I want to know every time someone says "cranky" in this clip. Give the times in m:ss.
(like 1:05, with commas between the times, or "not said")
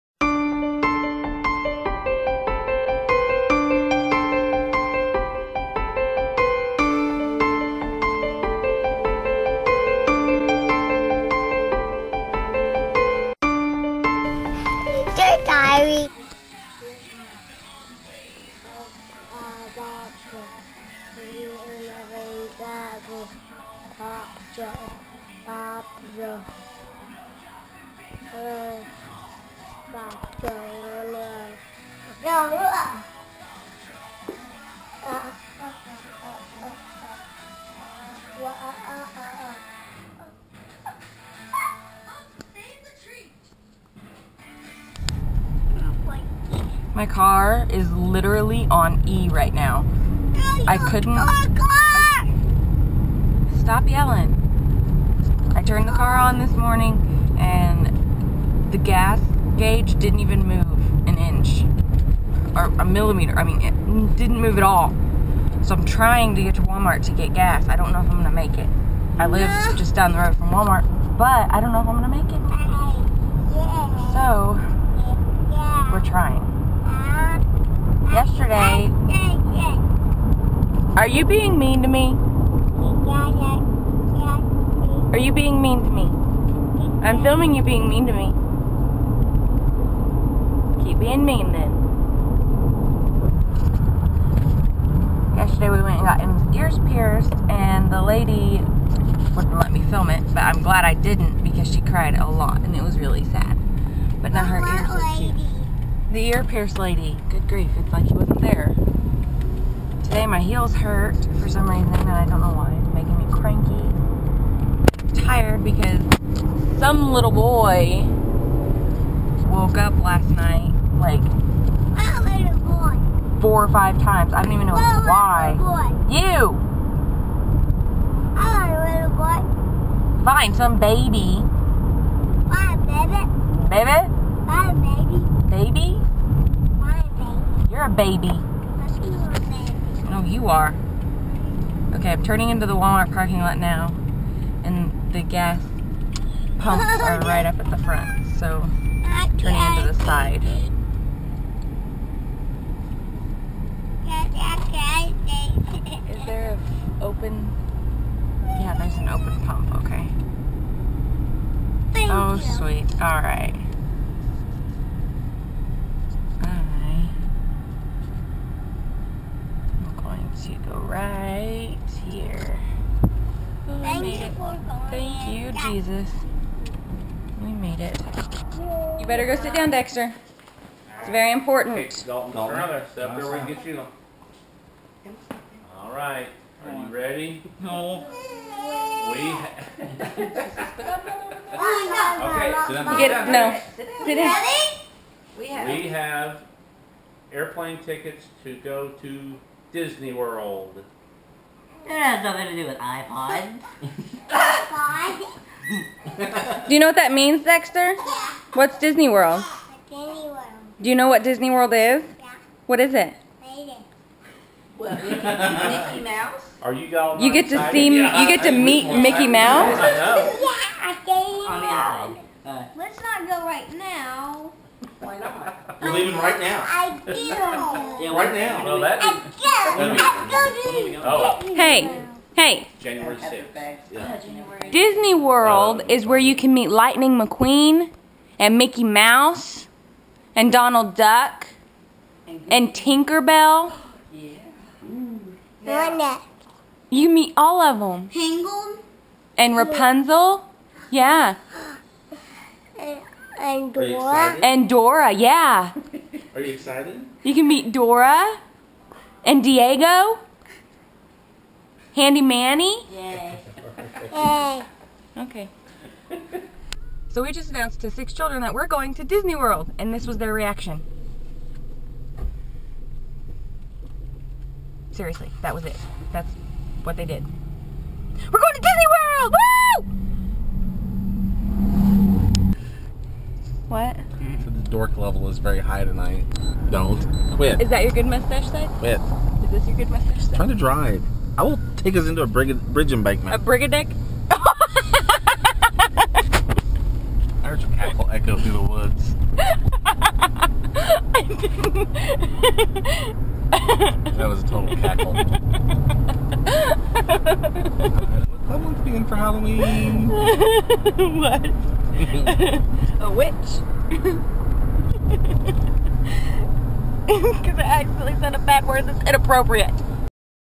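1:53.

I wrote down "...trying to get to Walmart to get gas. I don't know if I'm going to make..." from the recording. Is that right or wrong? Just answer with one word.
right.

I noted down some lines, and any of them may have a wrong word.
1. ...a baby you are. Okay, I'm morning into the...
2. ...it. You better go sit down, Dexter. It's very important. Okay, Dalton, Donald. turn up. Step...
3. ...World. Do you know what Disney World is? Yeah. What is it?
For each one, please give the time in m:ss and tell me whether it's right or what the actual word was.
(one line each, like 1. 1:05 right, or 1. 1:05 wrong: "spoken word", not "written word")
1. 2:17 wrong: "turning", not "morning"
2. 2:57 wrong: "Dalton", not "Donald"
3. 3:30 right.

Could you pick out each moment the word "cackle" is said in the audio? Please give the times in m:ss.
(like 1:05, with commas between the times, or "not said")
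4:57, 5:04.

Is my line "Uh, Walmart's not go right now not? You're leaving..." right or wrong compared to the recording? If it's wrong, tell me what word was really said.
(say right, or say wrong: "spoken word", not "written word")
wrong: "Let", not "Walmart".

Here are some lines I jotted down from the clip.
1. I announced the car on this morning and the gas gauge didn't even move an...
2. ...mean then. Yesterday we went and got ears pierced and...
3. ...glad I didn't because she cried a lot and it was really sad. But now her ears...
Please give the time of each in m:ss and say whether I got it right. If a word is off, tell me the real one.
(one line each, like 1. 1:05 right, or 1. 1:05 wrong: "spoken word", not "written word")
1. 0:55 wrong: "turned", not "announced"
2. 1:31 right
3. 1:40 right.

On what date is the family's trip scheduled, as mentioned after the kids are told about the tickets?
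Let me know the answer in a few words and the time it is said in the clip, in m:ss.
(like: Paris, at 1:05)
January 6, at 3:52.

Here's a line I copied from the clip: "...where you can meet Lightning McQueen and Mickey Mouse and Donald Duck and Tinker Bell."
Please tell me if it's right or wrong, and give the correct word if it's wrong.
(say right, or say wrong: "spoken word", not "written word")
right.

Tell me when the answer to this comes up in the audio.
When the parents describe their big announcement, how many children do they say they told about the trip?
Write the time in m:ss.
4:27.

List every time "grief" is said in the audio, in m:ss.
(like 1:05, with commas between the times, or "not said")
1:47.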